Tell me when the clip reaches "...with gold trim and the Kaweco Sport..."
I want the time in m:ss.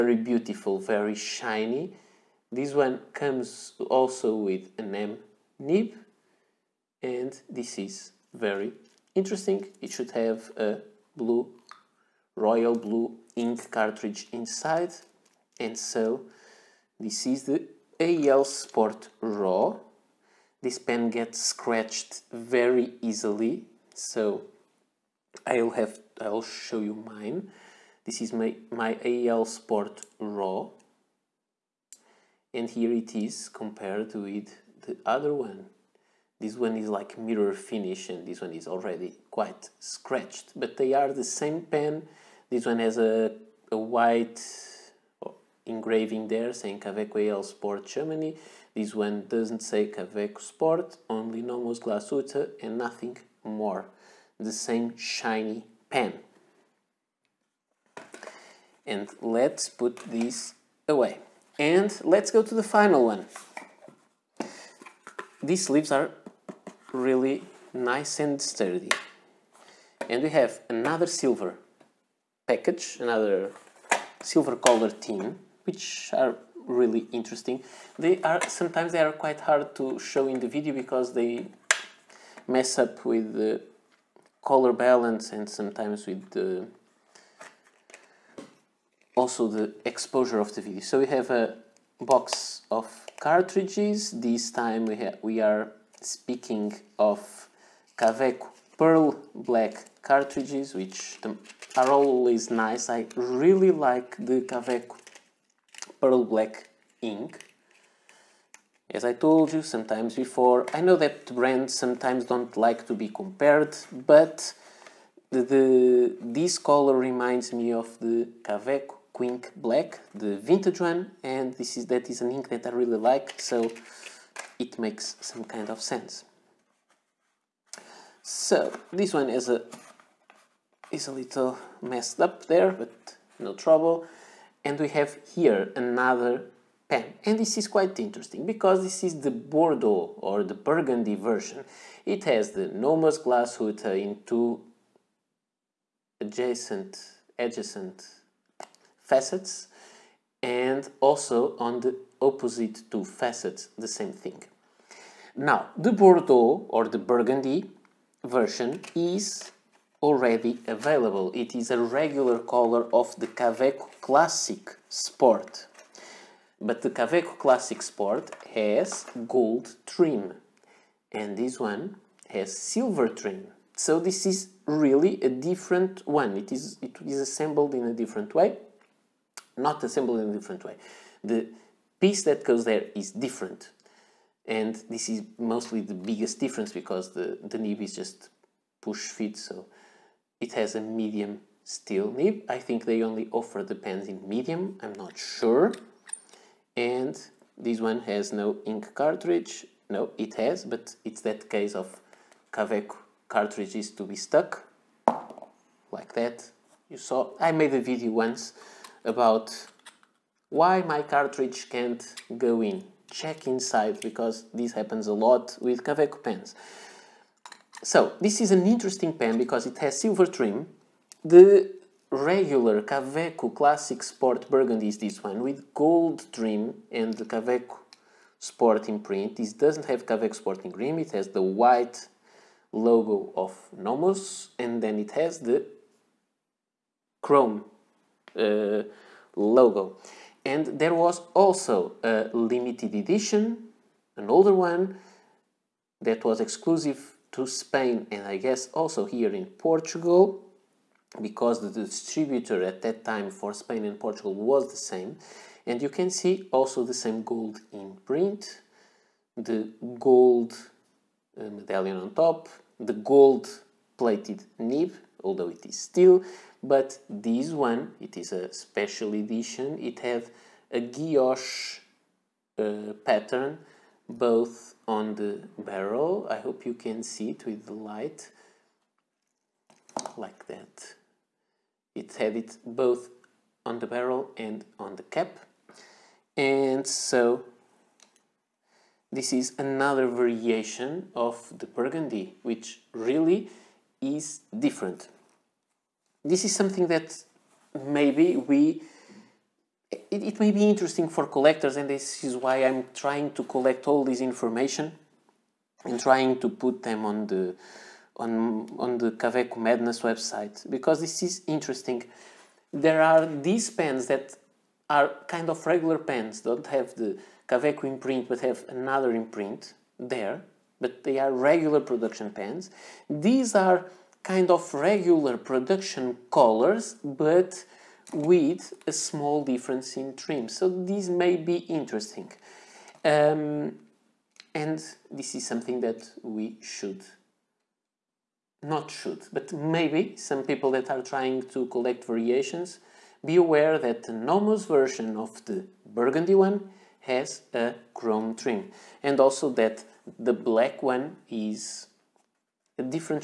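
3:45.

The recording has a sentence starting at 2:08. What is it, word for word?
So this one is a is a little messed up there, but no trouble and we have here another pen.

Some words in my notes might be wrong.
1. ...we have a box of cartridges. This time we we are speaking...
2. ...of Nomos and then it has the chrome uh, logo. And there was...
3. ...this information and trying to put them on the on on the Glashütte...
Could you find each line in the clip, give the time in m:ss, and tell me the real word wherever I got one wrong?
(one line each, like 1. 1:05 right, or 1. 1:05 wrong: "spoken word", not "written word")
1. 1:31 right
2. 3:53 right
3. 5:04 wrong: "Kaweco", not "Glashütte".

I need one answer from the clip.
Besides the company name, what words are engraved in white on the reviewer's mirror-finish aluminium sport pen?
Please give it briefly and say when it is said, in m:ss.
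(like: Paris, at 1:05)
Kaweco Sport Germany, at 0:46.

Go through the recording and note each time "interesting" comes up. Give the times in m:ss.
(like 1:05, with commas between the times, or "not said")
0:09, 1:17, 2:17, 3:38, 5:00, 5:11, 5:31.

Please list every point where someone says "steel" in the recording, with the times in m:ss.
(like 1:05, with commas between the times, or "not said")
3:11, 4:25.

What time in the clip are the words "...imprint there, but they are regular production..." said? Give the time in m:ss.
5:19.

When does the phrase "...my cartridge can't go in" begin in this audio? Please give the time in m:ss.
3:30.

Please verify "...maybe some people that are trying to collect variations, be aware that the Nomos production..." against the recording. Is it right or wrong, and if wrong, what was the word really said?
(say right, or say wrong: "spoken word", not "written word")
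wrong: "version", not "production".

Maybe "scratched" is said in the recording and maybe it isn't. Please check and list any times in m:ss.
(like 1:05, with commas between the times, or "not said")
0:21, 0:39.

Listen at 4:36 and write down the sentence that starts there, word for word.
I hope you can see it with the light like that.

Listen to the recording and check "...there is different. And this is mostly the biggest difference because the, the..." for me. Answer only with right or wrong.
right.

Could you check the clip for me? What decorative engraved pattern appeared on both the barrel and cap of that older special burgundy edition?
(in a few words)
Guilloche.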